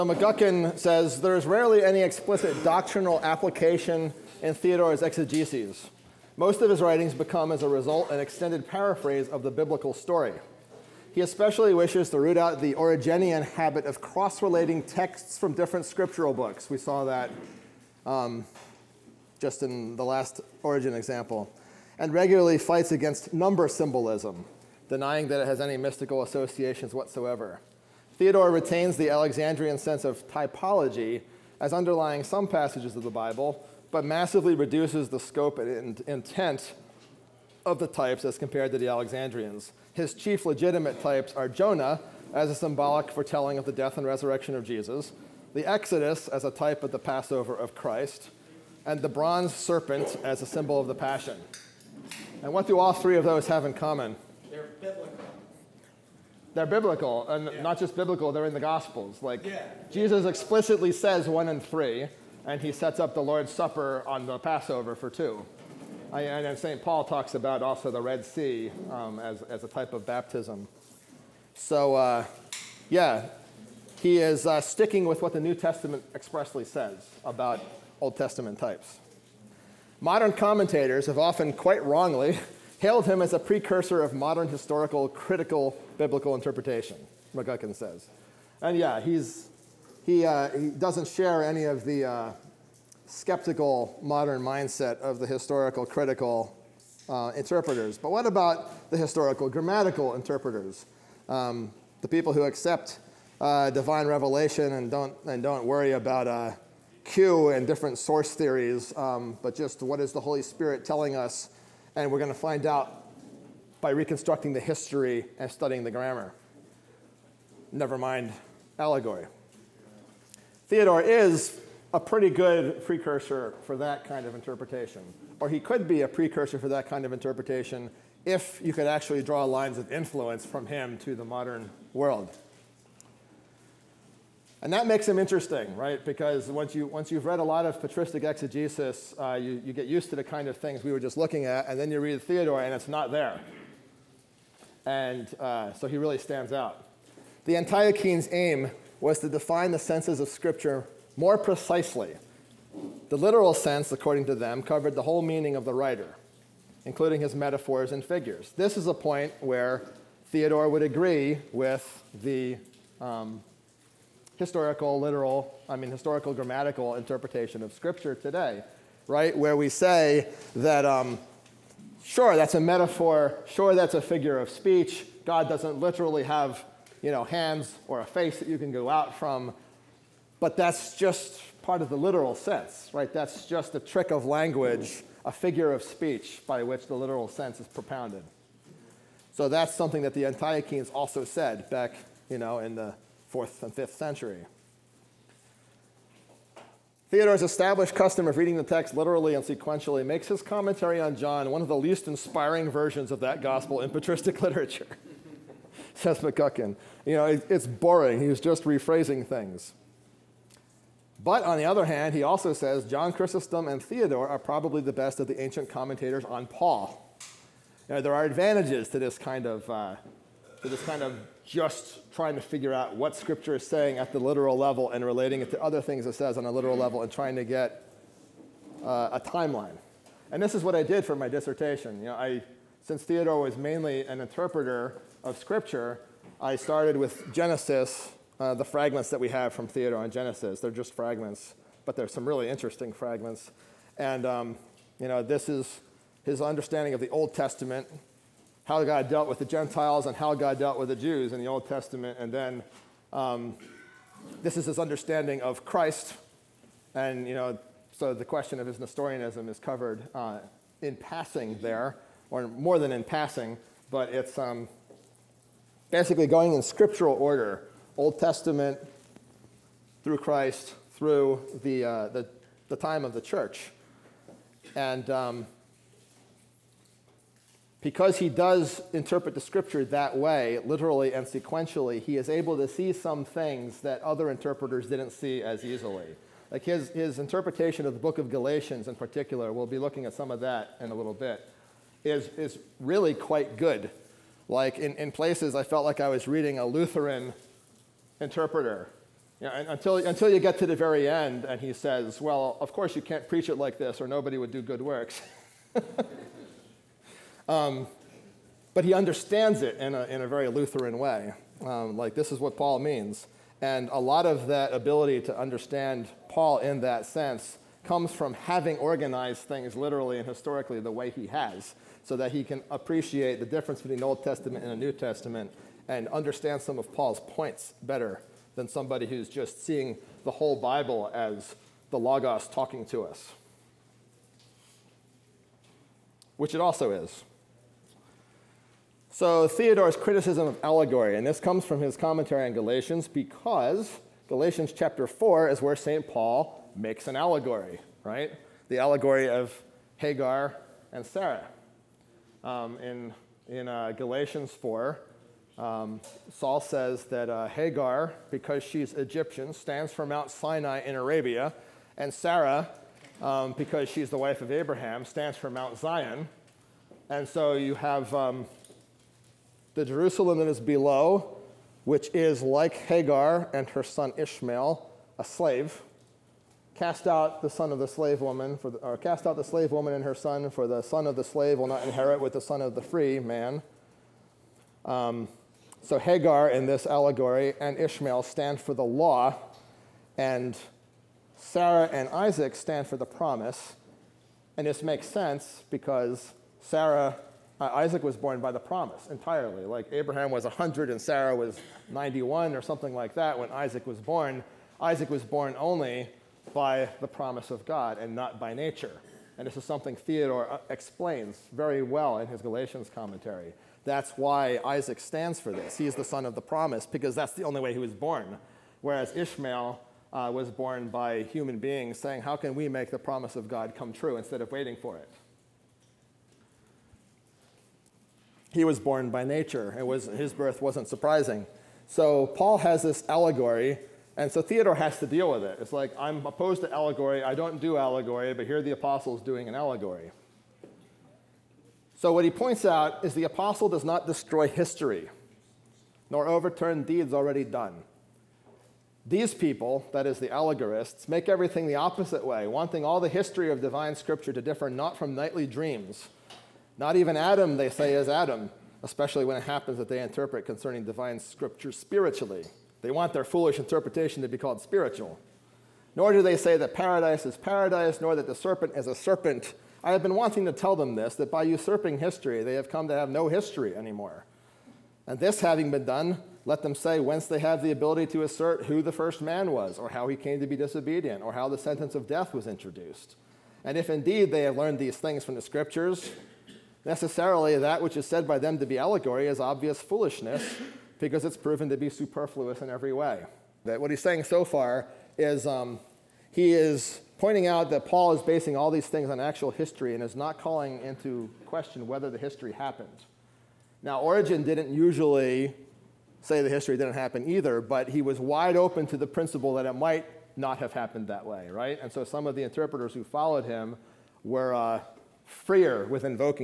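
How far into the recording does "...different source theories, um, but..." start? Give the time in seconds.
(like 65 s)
107 s.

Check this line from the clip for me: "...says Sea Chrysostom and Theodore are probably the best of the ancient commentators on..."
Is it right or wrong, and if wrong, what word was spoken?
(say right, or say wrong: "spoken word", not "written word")
wrong: "John", not "Sea".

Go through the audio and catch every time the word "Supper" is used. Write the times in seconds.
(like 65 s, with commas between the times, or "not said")
63 s.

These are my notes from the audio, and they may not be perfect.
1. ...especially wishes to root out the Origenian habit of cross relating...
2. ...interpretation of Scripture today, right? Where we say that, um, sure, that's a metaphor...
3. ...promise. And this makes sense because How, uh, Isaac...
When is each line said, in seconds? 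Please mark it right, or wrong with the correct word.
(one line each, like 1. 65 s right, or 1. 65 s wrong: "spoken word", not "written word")
1. 11 s right
2. 166 s right
3. 393 s wrong: "Sarah", not "How".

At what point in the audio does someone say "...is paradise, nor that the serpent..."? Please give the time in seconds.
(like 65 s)
467 s.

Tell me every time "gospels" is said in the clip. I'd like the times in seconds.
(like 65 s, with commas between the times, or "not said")
58 s, 203 s.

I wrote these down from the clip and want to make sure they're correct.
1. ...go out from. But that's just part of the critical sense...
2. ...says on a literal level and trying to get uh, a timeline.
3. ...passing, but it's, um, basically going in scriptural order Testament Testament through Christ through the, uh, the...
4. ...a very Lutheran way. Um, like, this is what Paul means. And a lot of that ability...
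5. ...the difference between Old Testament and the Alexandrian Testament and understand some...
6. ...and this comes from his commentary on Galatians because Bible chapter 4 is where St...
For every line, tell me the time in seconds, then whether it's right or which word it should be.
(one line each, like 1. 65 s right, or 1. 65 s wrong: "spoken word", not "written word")
1. 178 s wrong: "literal", not "critical"
2. 226 s right
3. 263 s wrong: "Old", not "Testament"
4. 310 s right
5. 323 s wrong: "New", not "Alexandrian"
6. 341 s wrong: "Galatians", not "Bible".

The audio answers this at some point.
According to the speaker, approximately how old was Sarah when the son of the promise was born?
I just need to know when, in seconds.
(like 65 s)
401 s.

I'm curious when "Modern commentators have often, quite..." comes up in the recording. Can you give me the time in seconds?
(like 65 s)
80 s.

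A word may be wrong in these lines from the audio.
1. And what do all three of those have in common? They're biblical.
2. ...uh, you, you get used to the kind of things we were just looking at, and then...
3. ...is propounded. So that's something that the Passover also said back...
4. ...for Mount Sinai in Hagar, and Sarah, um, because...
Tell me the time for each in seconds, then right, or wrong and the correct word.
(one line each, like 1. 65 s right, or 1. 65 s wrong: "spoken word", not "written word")
1. 52 s right
2. 139 s right
3. 187 s wrong: "Antiochians", not "Passover"
4. 359 s wrong: "Arabia", not "Hagar".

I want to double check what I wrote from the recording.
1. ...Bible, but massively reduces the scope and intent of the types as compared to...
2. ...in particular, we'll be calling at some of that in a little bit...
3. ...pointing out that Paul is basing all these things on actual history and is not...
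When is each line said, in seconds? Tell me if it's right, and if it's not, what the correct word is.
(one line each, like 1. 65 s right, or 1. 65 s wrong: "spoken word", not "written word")
1. 33 s right
2. 288 s wrong: "looking", not "calling"
3. 497 s right.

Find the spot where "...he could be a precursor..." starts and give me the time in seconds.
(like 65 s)
125 s.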